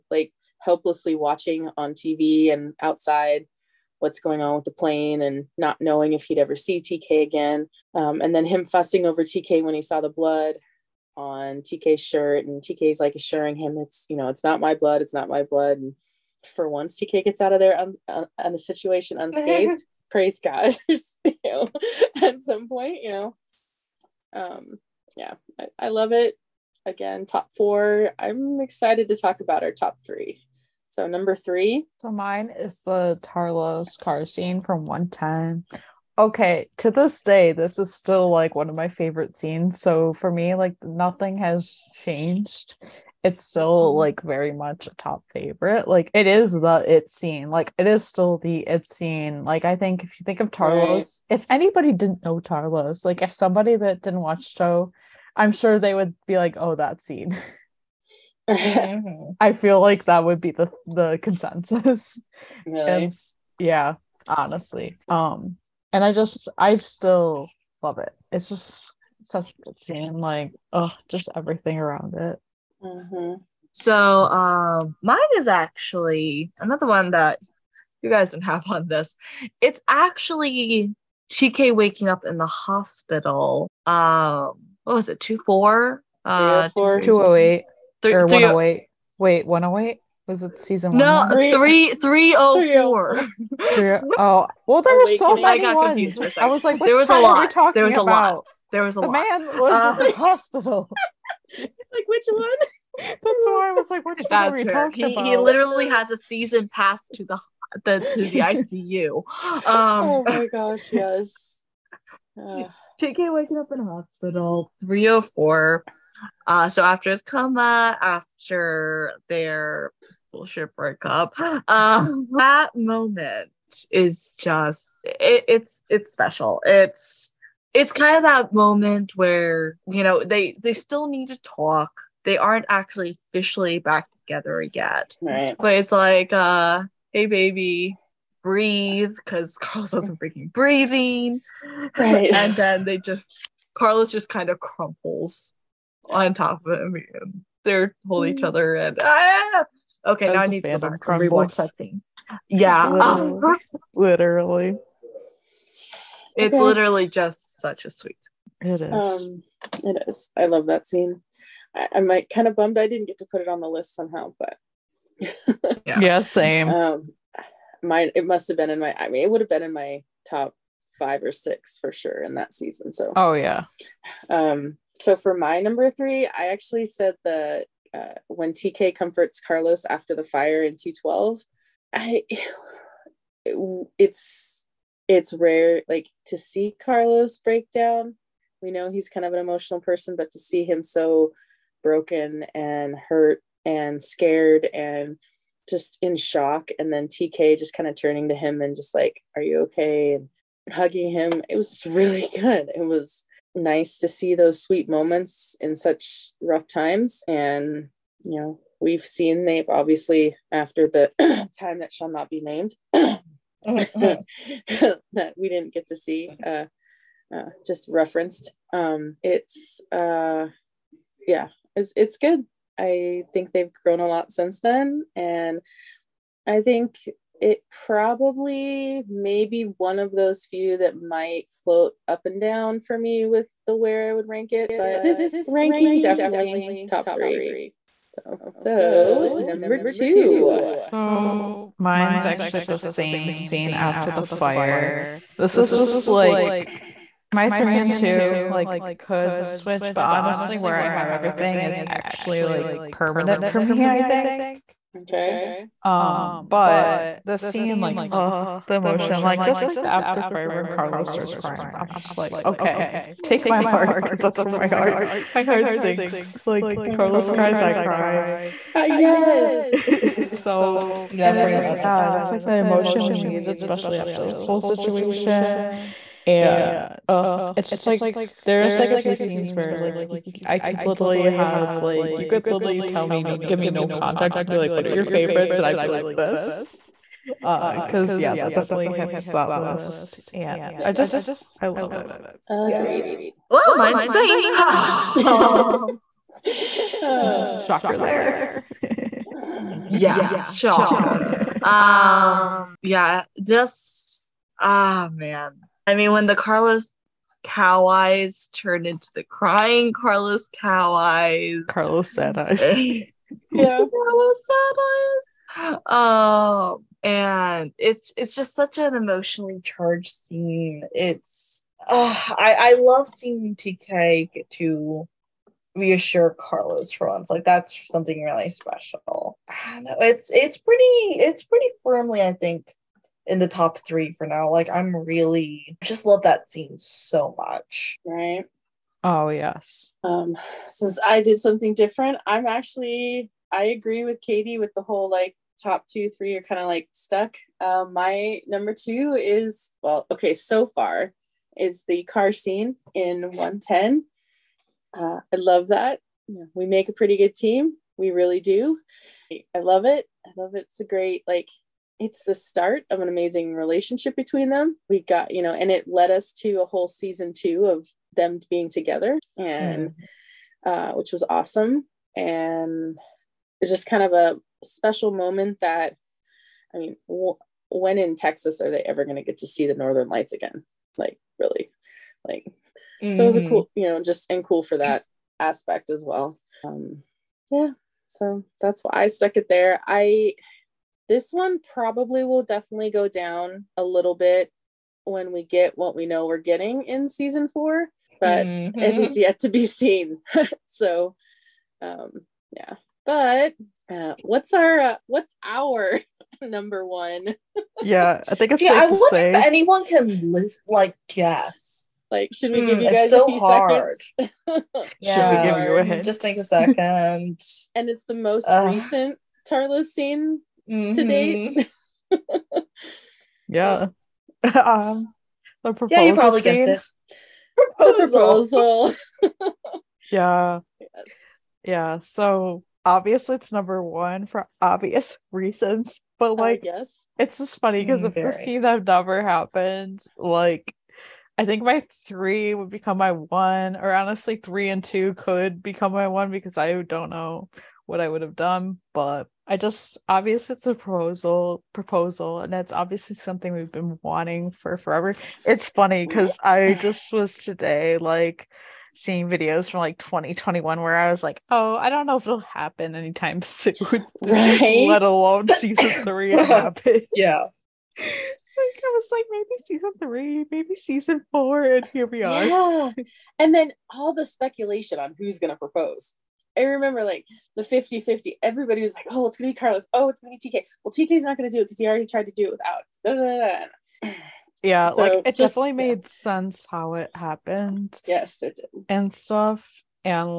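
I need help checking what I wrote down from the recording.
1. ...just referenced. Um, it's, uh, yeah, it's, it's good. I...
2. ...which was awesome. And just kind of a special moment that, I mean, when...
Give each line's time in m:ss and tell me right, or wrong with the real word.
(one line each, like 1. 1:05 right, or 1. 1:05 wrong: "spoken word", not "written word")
1. 3:37 right
2. 6:10 right.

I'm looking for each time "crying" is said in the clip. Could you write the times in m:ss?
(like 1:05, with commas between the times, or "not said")
4:21, 5:09.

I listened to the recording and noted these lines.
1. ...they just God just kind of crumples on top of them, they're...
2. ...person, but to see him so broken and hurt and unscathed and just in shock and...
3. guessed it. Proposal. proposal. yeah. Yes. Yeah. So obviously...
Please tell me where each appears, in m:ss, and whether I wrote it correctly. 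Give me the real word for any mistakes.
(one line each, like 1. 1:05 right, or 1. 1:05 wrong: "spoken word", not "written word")
1. 2:22 wrong: "Carlos", not "God"
2. 3:09 wrong: "scared", not "unscathed"
3. 7:06 right.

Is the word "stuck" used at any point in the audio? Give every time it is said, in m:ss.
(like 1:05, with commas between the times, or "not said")
5:46, 6:29.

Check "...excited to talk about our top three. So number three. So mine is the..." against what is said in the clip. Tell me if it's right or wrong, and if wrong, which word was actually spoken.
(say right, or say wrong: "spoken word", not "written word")
right.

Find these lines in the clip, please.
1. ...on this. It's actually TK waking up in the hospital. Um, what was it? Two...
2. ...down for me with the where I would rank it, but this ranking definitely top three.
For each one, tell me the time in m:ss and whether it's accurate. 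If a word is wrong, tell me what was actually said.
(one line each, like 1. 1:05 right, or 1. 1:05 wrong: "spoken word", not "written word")
1. 1:18 right
2. 3:52 right.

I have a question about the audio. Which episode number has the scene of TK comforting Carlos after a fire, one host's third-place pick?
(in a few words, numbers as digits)
212.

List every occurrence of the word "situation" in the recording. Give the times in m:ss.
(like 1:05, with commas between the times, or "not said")
0:18, 4:34.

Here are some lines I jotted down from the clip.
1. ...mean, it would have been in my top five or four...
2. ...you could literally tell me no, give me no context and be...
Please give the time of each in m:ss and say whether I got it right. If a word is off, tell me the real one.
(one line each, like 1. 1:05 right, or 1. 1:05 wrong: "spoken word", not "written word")
1. 2:49 wrong: "six", not "four"
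2. 4:42 right.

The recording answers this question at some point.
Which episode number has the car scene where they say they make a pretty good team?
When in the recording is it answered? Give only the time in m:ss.
5:53.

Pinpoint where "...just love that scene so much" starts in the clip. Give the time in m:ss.
5:35.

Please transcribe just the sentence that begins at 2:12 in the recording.
They aren't actually officially back together yet, right.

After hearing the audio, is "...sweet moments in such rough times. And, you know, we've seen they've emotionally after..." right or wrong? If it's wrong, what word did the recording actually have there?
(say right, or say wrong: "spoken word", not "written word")
wrong: "obviously", not "emotionally".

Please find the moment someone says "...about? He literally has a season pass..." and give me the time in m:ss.
1:45.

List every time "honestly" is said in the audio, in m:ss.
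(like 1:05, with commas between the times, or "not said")
1:04, 4:10, 7:23.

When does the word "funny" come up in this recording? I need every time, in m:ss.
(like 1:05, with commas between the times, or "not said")
7:17, 7:35.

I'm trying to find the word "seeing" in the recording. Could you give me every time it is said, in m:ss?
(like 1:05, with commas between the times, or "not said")
5:23, 7:38.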